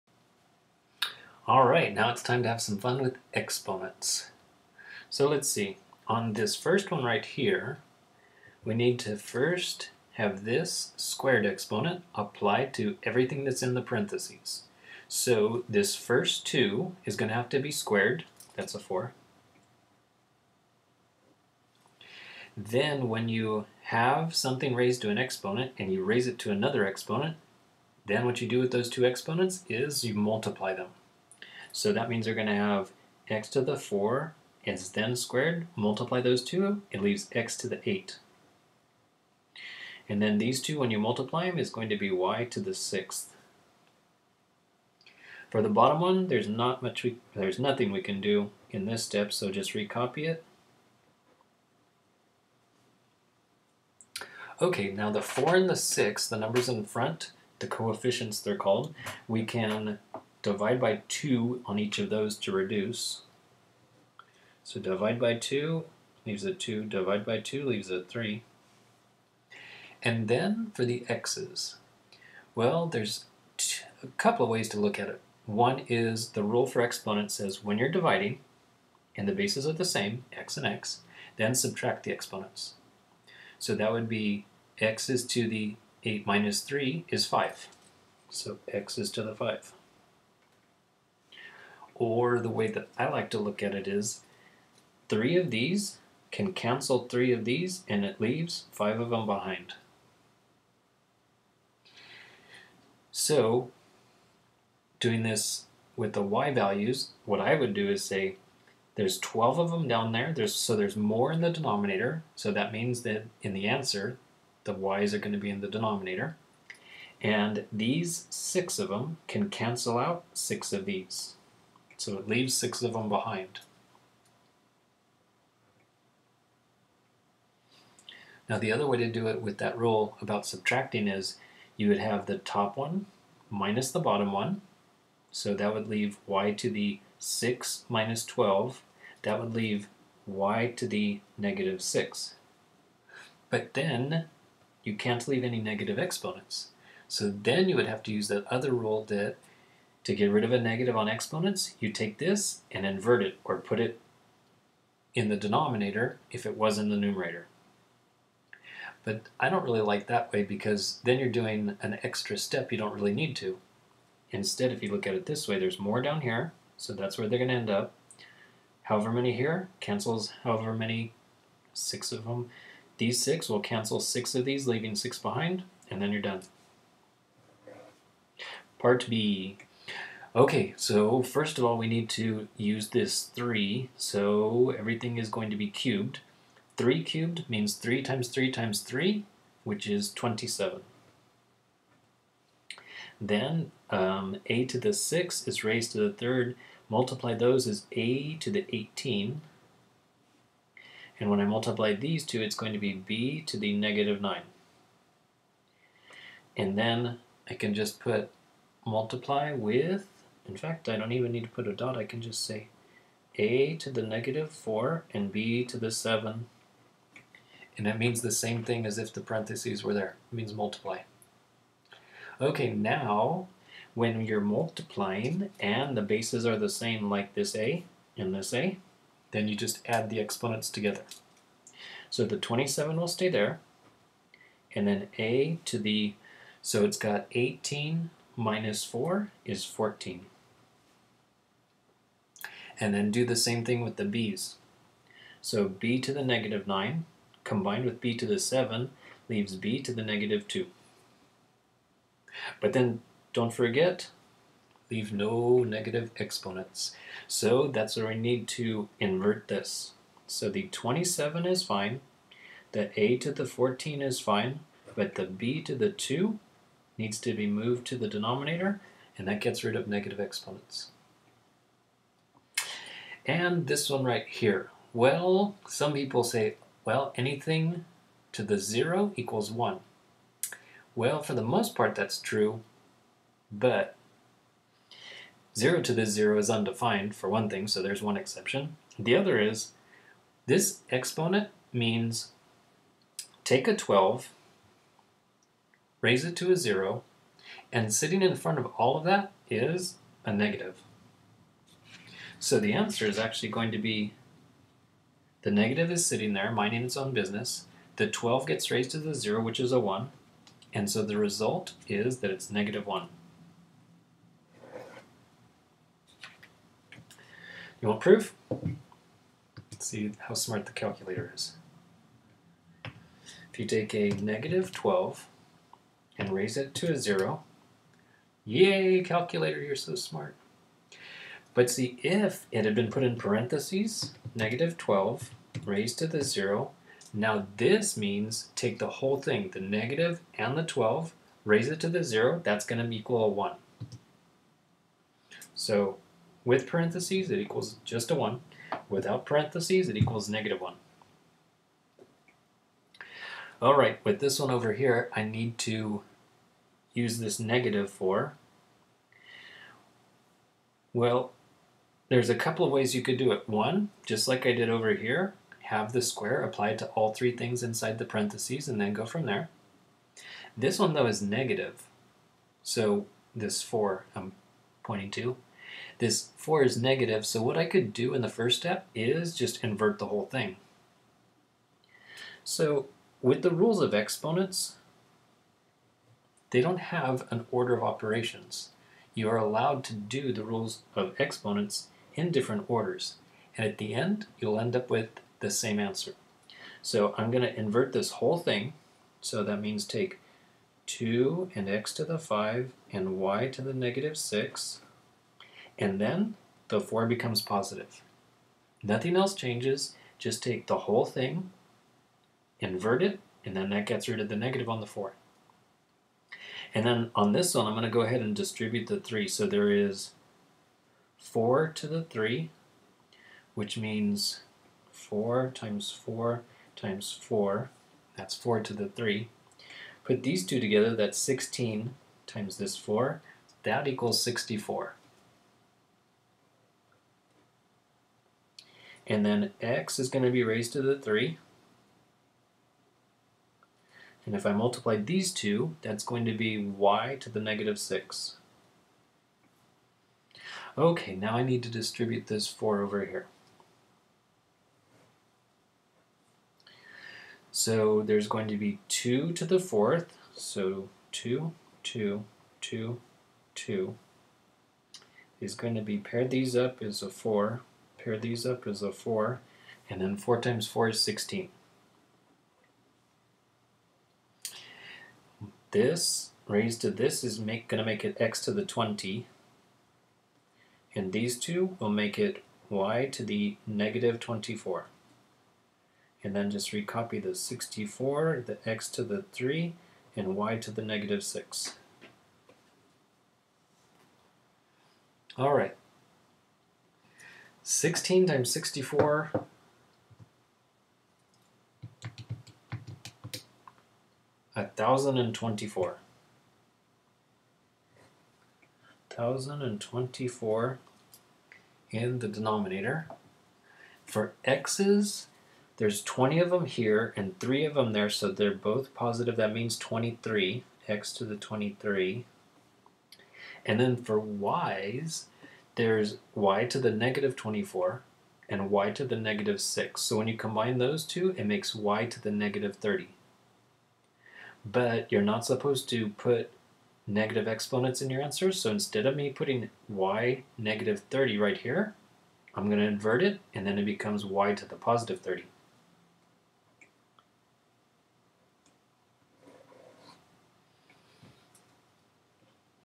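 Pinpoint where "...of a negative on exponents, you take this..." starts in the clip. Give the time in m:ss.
2:30.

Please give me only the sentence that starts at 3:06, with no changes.
3 cubed means 3 times 3 times 3, which is 27.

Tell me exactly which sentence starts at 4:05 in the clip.
So b to the negative 9 combined with b to the 7 leaves b to the negative 2.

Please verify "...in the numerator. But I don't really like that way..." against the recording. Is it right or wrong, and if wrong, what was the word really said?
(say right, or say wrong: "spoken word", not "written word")
right.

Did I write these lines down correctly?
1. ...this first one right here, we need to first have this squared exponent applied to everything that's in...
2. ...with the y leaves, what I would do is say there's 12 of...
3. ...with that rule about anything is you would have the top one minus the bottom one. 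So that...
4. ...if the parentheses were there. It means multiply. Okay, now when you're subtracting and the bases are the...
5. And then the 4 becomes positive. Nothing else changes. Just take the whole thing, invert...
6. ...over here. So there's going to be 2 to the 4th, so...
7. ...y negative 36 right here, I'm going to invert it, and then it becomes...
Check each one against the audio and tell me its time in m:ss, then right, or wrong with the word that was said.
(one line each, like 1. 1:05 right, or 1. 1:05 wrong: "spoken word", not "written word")
1. 0:06 right
2. 1:45 wrong: "values", not "leaves"
3. 2:09 wrong: "subtracting", not "anything"
4. 3:38 wrong: "multiplying", not "subtracting"
5. 6:45 right
6. 7:32 right
7. 8:59 wrong: "30", not "36".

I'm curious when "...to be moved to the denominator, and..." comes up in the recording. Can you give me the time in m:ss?
4:27.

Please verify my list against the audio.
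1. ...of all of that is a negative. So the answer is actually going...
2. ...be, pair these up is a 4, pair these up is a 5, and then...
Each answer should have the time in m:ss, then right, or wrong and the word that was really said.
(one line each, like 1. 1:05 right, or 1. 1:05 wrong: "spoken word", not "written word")
1. 4:58 right
2. 7:45 wrong: "4", not "5".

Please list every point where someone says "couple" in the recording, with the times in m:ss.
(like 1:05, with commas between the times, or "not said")
1:14, 6:02.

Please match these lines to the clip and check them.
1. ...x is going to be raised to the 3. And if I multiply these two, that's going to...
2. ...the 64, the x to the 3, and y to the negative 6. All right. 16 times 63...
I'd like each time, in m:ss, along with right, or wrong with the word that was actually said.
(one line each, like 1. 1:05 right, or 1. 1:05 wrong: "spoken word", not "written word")
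1. 7:19 right
2. 8:07 wrong: "64", not "63".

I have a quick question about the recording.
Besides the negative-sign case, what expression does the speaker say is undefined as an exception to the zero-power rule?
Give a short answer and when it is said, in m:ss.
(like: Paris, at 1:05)
0 to the 0, at 4:45.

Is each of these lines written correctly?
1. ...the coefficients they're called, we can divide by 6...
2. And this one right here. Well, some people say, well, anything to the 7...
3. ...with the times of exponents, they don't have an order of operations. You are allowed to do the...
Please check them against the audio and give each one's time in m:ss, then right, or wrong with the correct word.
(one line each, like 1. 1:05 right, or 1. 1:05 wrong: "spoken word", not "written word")
1. 0:57 wrong: "2", not "6"
2. 4:33 wrong: "0", not "7"
3. 6:23 wrong: "rules", not "times".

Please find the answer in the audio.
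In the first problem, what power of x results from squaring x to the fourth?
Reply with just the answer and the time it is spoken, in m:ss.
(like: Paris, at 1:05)
x to the 8, at 0:37.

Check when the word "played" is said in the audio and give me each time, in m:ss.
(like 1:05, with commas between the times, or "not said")
not said.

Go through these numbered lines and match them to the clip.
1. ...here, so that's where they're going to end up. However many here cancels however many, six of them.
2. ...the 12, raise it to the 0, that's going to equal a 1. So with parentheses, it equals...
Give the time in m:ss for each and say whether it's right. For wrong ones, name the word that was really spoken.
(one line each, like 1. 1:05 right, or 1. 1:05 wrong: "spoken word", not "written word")
1. 2:46 right
2. 5:40 right.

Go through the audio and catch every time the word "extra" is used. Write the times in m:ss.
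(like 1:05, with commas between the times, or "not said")
2:42.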